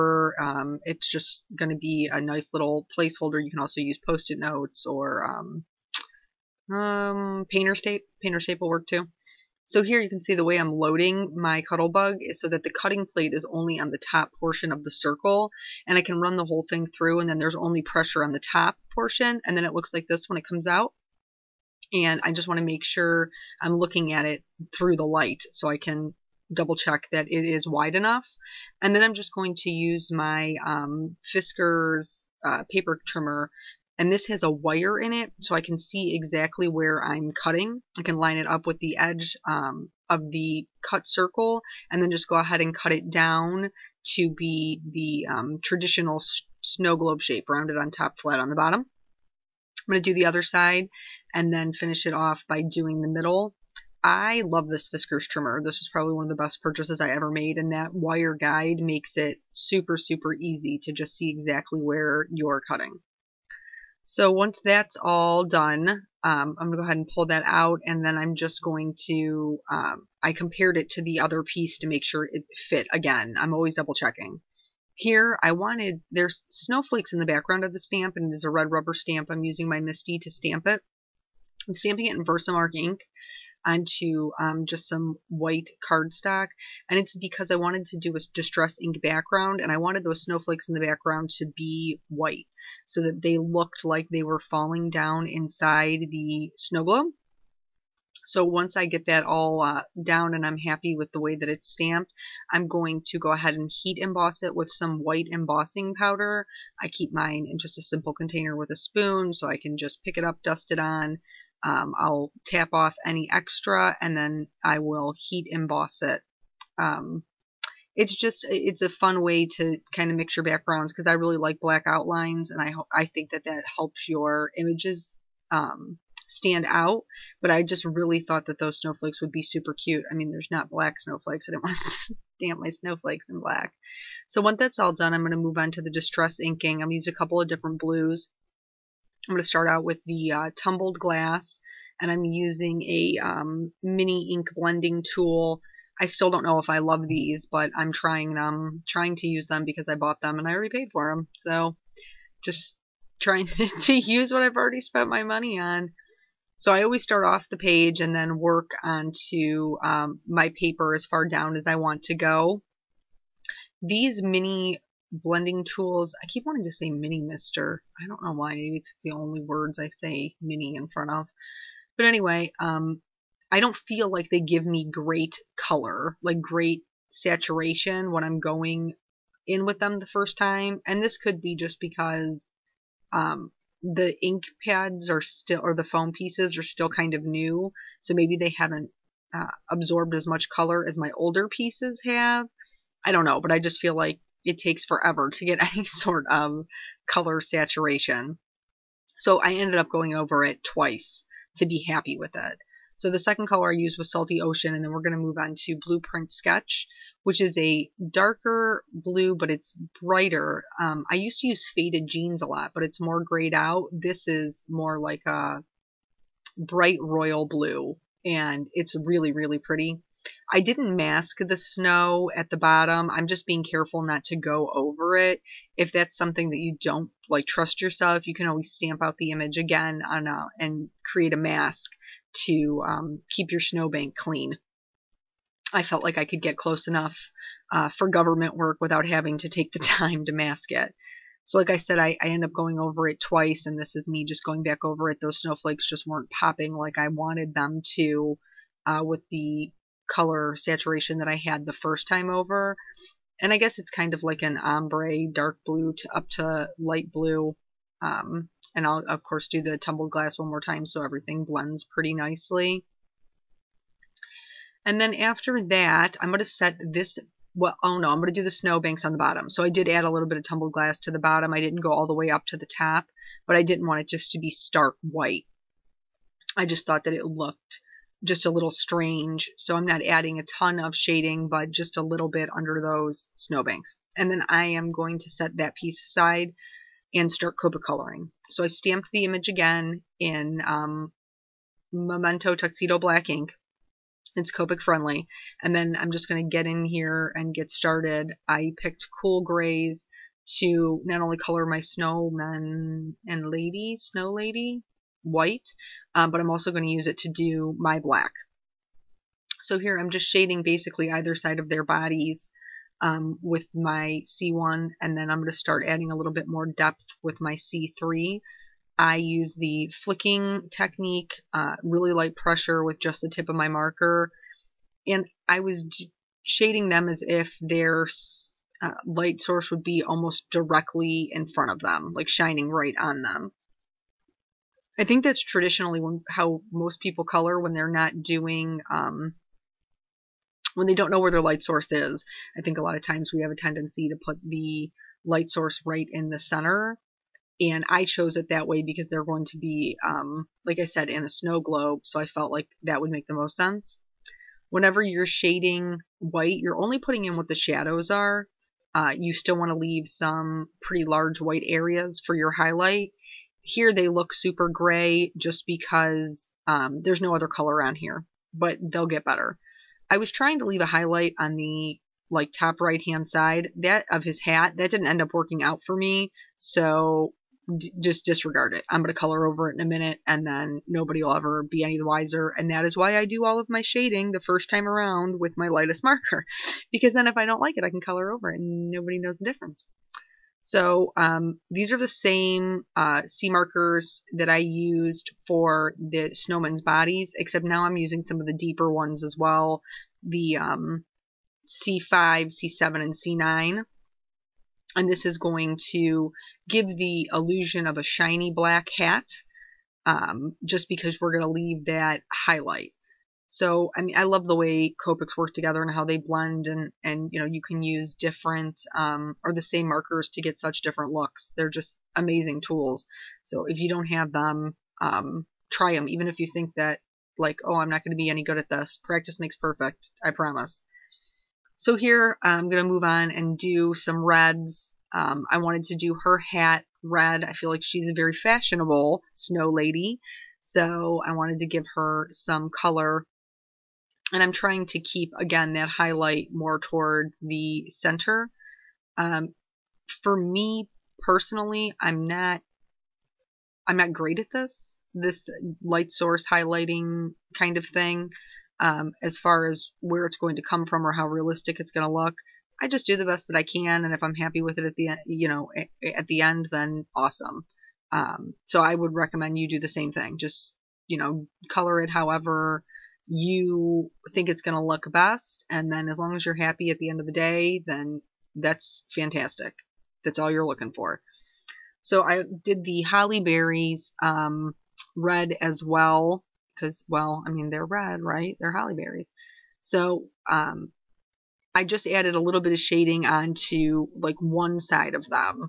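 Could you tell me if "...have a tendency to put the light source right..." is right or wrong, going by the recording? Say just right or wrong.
right.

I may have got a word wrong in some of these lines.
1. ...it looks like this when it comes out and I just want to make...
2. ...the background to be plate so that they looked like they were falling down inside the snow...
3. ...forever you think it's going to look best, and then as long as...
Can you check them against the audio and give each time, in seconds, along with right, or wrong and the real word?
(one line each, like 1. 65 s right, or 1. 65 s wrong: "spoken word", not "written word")
1. 19 s right
2. 90 s wrong: "white", not "plate"
3. 472 s wrong: "however", not "forever".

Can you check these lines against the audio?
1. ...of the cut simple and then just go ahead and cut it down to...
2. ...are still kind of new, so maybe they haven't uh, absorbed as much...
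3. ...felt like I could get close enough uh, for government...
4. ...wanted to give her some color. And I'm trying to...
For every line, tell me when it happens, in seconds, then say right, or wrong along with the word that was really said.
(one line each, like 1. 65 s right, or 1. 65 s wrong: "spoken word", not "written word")
1. 40 s wrong: "circle", not "simple"
2. 186 s right
3. 235 s right
4. 441 s right.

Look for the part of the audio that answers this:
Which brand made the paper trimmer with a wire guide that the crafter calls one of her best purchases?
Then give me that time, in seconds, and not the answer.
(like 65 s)
54 s.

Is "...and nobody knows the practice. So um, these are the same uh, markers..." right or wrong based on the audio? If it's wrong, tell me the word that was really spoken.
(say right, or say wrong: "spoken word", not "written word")
wrong: "difference", not "practice".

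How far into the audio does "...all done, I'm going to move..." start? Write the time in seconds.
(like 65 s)
134 s.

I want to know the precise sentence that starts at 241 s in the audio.
So, like I said, I, I end up going over it twice, and this is me just going back over it.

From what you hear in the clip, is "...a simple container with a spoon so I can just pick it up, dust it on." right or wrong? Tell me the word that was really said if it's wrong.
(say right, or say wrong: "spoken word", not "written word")
right.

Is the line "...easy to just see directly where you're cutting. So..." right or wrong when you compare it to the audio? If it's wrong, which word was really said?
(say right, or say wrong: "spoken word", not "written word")
wrong: "exactly", not "directly".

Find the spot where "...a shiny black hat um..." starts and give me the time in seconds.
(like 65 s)
407 s.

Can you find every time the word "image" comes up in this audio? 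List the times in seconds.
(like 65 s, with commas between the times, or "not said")
124 s, 229 s, 289 s.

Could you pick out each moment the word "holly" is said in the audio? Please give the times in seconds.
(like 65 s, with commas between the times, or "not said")
483 s, 488 s.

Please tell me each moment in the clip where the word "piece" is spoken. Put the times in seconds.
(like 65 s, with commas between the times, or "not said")
71 s, 186 s, 191 s, 285 s.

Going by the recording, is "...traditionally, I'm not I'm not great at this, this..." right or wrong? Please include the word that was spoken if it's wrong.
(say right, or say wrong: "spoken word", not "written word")
wrong: "personally", not "traditionally".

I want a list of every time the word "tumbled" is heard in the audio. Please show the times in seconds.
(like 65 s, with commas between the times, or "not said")
140 s, 259 s, 270 s.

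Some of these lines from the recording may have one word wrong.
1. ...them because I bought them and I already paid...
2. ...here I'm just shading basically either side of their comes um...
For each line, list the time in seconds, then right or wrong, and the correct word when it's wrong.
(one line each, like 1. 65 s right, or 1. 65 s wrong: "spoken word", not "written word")
1. 149 s right
2. 309 s wrong: "bodies", not "comes".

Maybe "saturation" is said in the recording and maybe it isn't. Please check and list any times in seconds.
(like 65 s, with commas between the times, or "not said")
177 s, 197 s, 250 s.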